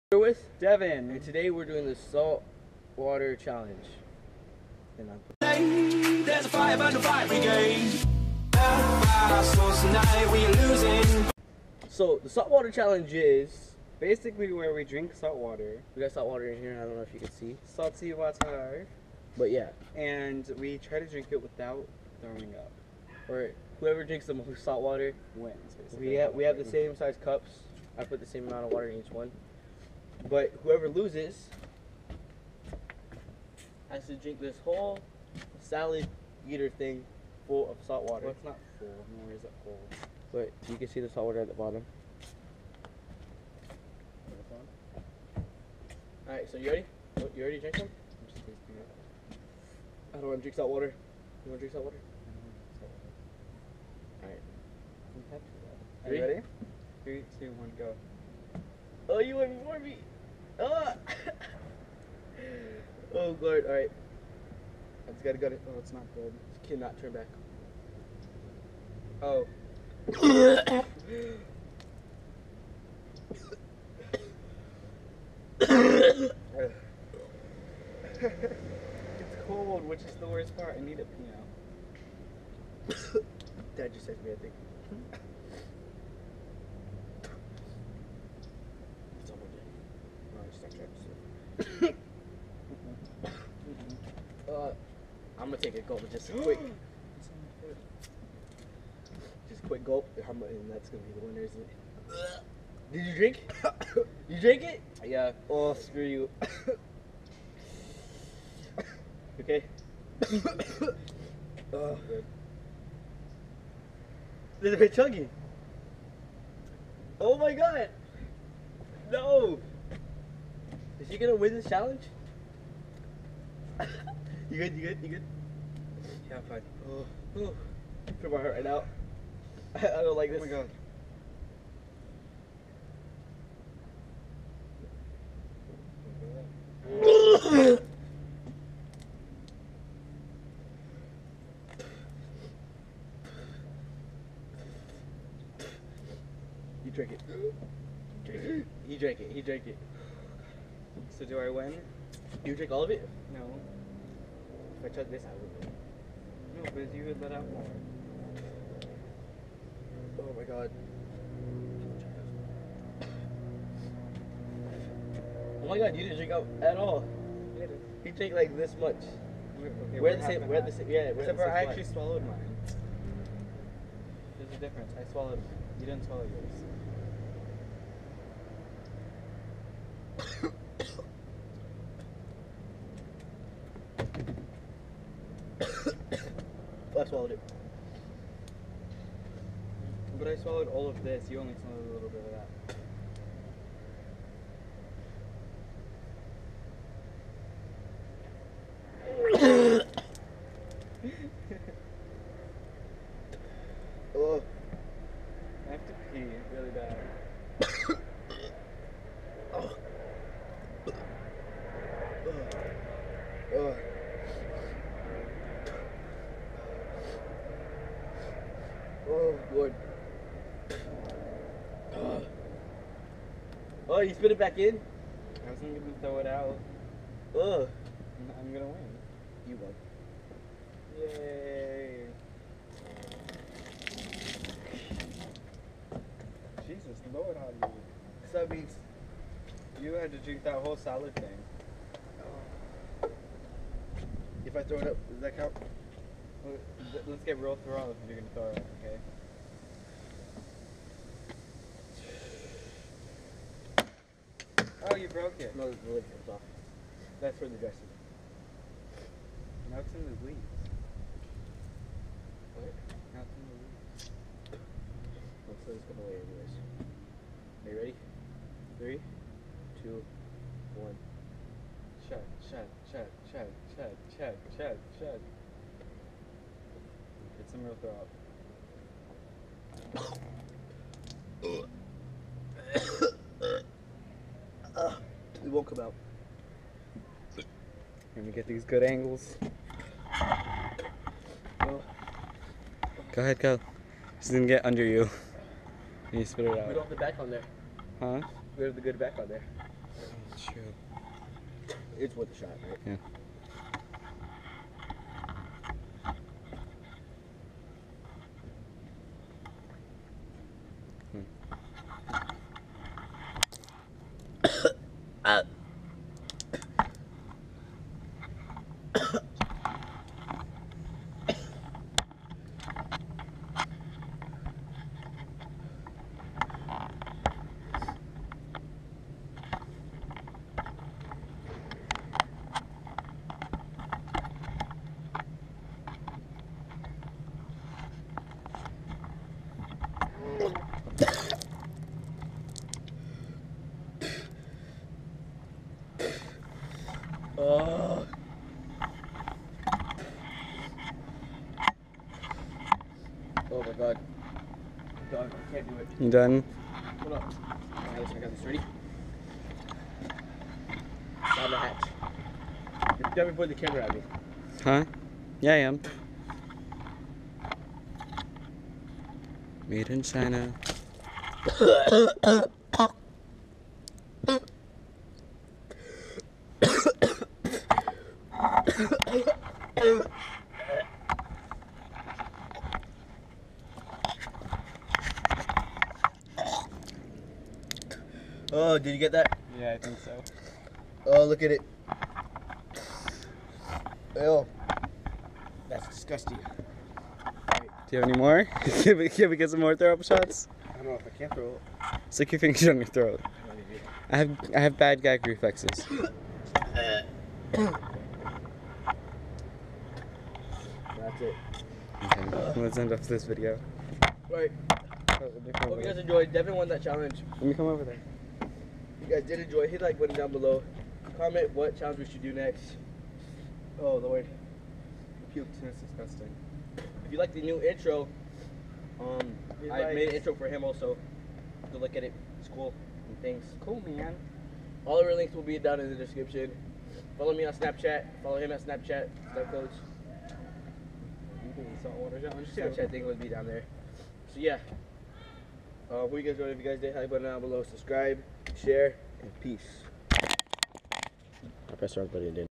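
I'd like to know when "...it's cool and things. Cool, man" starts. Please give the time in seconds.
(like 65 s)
432 s.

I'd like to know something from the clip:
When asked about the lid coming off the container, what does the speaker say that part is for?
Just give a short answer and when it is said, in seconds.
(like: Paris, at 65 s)
The dressing, at 257 s.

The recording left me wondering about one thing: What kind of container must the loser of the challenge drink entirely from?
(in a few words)
Salad eater thing.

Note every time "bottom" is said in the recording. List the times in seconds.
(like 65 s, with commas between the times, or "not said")
41 s.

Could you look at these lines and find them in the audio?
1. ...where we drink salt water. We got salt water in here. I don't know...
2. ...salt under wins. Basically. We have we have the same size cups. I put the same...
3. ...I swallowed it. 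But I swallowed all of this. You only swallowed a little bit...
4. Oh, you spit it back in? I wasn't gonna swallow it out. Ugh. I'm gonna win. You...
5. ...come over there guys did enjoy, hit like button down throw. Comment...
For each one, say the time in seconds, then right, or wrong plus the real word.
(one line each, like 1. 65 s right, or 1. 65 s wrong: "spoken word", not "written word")
1. 14 s right
2. 24 s wrong: "water", not "under"
3. 186 s right
4. 223 s wrong: "throw", not "swallow"
5. 417 s wrong: "below", not "throw".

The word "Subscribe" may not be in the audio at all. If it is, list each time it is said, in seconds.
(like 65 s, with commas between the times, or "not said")
447 s.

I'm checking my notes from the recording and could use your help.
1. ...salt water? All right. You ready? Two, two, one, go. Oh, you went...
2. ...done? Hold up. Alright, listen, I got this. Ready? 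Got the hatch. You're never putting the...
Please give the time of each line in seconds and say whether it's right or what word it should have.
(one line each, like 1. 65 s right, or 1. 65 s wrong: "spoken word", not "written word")
1. 51 s wrong: "Three", not "Two"
2. 356 s right.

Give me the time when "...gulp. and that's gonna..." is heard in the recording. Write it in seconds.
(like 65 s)
99 s.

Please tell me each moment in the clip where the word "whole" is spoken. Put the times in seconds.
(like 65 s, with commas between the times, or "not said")
34 s, 240 s.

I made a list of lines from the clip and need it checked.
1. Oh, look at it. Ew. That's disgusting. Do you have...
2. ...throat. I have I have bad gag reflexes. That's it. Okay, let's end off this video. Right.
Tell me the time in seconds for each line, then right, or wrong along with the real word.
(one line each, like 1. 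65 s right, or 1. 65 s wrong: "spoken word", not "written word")
1. 391 s right
2. 402 s right.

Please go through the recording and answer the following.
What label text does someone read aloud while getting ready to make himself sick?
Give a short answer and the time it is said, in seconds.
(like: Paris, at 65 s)
Made in China, at 369 s.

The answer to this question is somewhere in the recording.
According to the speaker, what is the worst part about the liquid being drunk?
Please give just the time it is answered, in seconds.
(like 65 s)
79 s.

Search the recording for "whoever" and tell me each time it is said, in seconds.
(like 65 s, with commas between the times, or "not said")
23 s, 30 s.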